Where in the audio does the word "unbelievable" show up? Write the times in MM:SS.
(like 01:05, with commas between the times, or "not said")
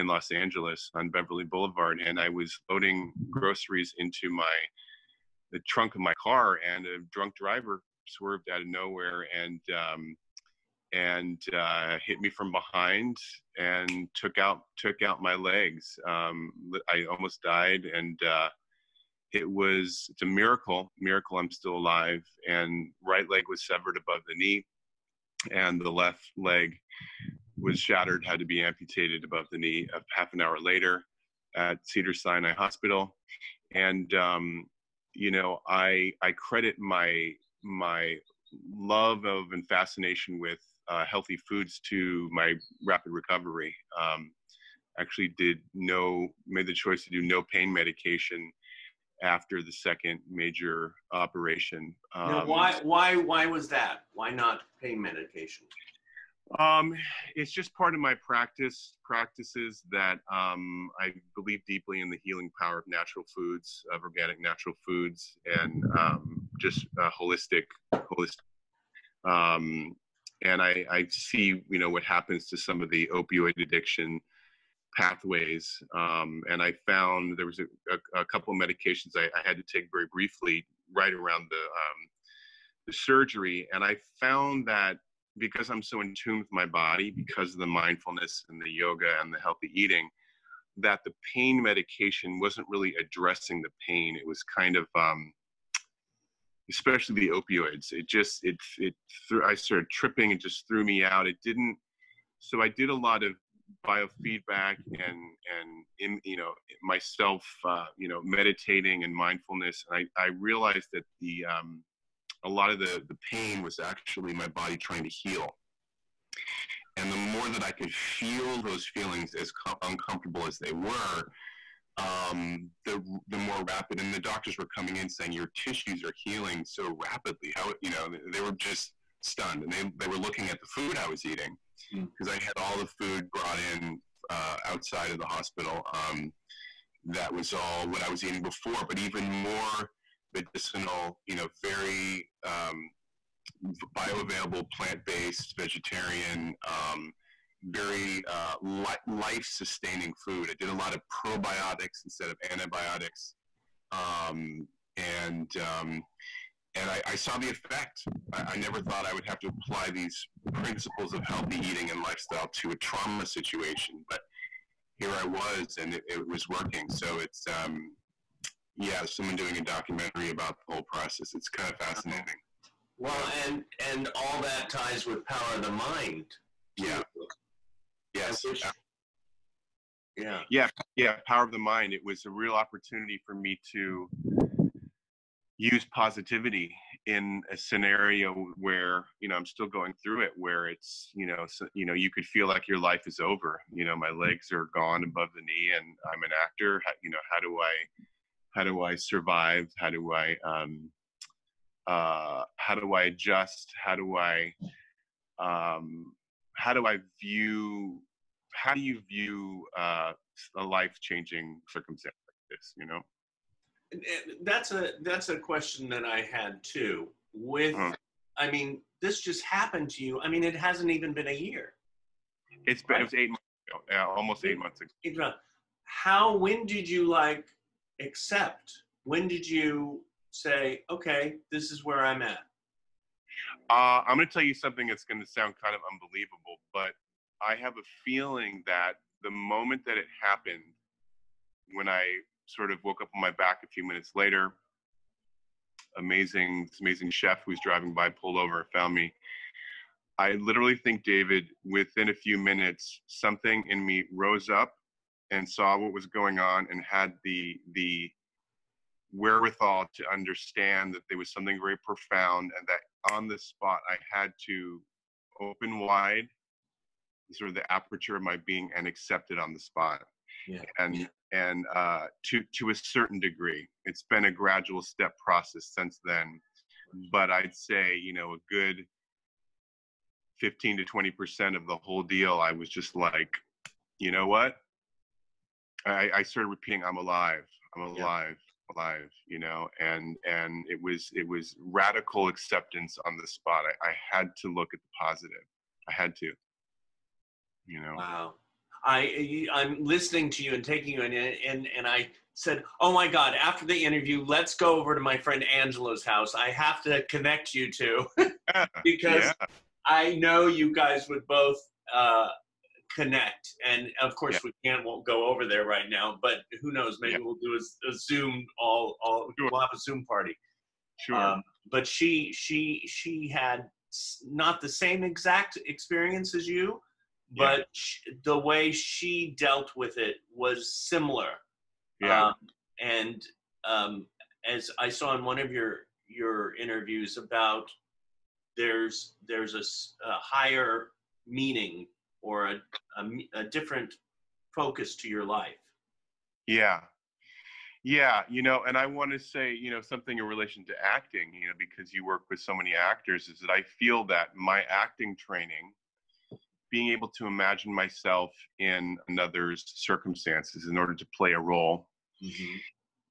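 03:55.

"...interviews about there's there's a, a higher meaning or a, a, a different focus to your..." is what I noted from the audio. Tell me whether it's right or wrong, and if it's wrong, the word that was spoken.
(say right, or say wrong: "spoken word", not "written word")
right.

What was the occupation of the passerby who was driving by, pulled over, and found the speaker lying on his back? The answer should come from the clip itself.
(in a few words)
Chef.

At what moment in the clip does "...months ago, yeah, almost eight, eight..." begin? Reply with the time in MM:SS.
03:43.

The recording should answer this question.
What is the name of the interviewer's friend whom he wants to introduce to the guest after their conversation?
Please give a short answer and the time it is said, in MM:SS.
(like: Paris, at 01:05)
Angela, at 05:05.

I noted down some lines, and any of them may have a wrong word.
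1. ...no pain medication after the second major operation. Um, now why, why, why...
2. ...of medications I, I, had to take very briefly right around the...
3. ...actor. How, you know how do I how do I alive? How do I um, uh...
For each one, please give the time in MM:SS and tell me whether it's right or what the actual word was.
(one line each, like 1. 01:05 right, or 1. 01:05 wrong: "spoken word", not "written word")
1. 00:47 right
2. 01:18 right
3. 03:16 wrong: "survive", not "alive".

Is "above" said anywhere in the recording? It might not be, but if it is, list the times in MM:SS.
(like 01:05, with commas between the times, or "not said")
00:23, 00:29, 03:15.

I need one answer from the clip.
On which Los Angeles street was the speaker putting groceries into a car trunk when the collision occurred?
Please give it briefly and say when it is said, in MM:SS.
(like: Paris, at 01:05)
Beverly Boulevard, at 00:01.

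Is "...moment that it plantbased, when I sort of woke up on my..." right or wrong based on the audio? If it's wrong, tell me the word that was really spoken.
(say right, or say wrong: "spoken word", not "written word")
wrong: "happened", not "plantbased".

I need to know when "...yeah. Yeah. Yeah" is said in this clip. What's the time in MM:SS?
03:00.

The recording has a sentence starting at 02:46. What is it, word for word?
So it's, um, yeah, someone doing a documentary about the whole process.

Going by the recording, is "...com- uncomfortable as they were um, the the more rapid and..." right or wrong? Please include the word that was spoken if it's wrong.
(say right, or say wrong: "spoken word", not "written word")
right.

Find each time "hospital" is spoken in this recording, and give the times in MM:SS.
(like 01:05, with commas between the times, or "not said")
00:32, 02:15.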